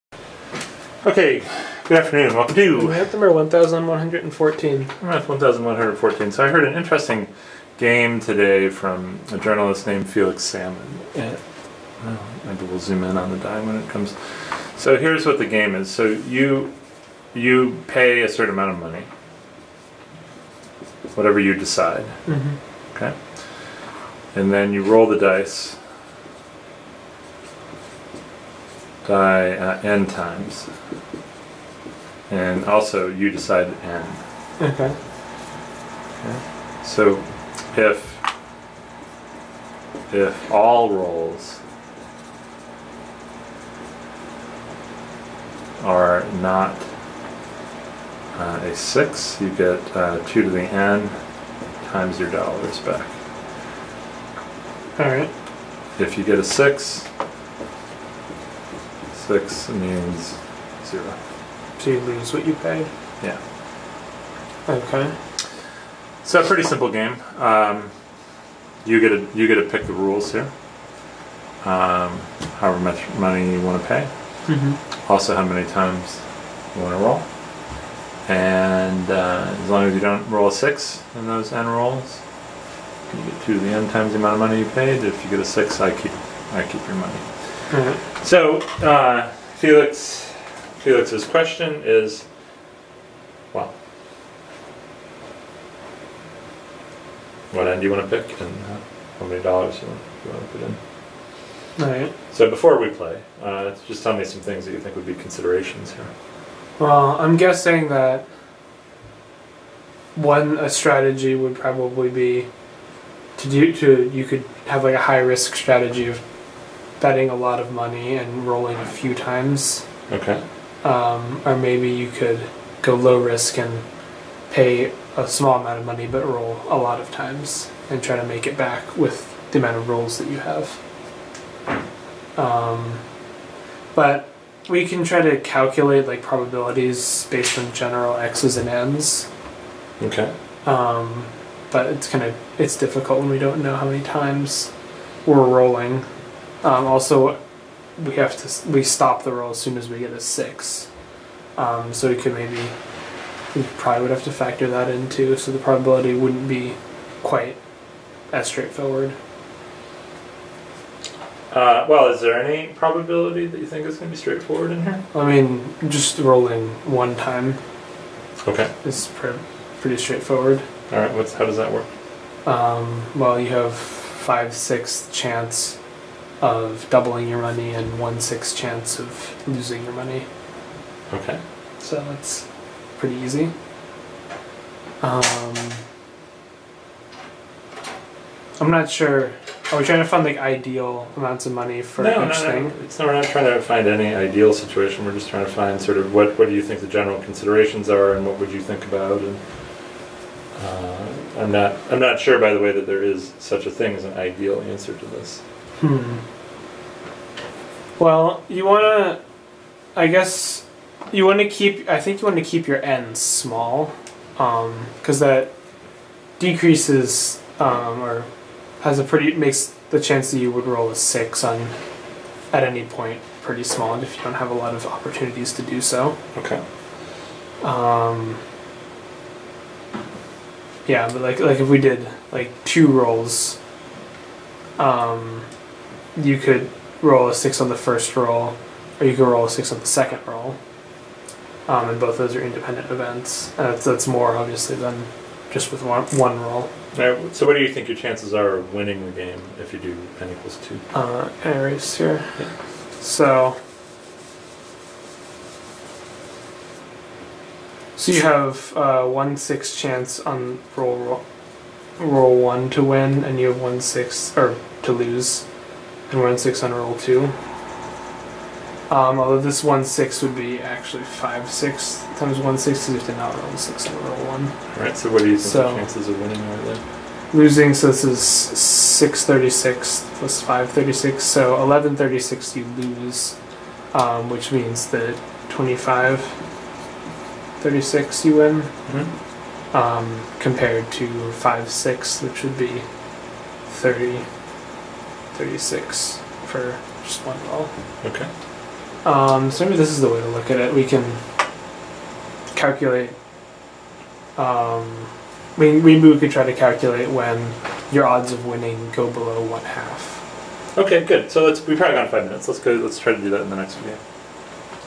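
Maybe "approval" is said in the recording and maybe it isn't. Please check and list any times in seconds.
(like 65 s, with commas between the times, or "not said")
not said.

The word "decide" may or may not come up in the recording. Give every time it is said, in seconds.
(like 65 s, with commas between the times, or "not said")
21 s, 33 s.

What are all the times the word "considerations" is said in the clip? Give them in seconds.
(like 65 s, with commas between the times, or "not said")
105 s, 197 s.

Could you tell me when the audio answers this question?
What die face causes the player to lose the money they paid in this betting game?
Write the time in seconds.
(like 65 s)
59 s.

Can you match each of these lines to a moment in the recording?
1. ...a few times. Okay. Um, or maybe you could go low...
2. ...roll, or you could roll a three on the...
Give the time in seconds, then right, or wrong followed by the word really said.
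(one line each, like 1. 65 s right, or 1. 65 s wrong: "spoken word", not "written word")
1. 118 s right
2. 238 s wrong: "six", not "three".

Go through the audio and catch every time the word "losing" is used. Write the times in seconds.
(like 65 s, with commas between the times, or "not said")
179 s, 277 s.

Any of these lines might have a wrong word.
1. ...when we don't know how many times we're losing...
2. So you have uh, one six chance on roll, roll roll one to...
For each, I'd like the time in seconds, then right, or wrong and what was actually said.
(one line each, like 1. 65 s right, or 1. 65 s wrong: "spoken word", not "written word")
1. 143 s wrong: "rolling", not "losing"
2. 257 s right.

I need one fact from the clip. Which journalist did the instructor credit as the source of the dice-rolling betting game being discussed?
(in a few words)
Felix Salmon.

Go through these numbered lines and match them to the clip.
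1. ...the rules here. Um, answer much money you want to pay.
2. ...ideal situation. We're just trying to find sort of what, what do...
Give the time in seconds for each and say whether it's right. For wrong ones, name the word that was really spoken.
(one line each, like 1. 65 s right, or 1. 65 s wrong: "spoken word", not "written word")
1. 69 s wrong: "however", not "answer"
2. 194 s right.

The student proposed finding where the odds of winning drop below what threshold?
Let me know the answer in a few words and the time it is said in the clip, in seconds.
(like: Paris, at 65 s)
1/2, at 309 s.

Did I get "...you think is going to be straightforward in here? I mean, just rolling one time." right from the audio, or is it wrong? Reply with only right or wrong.
right.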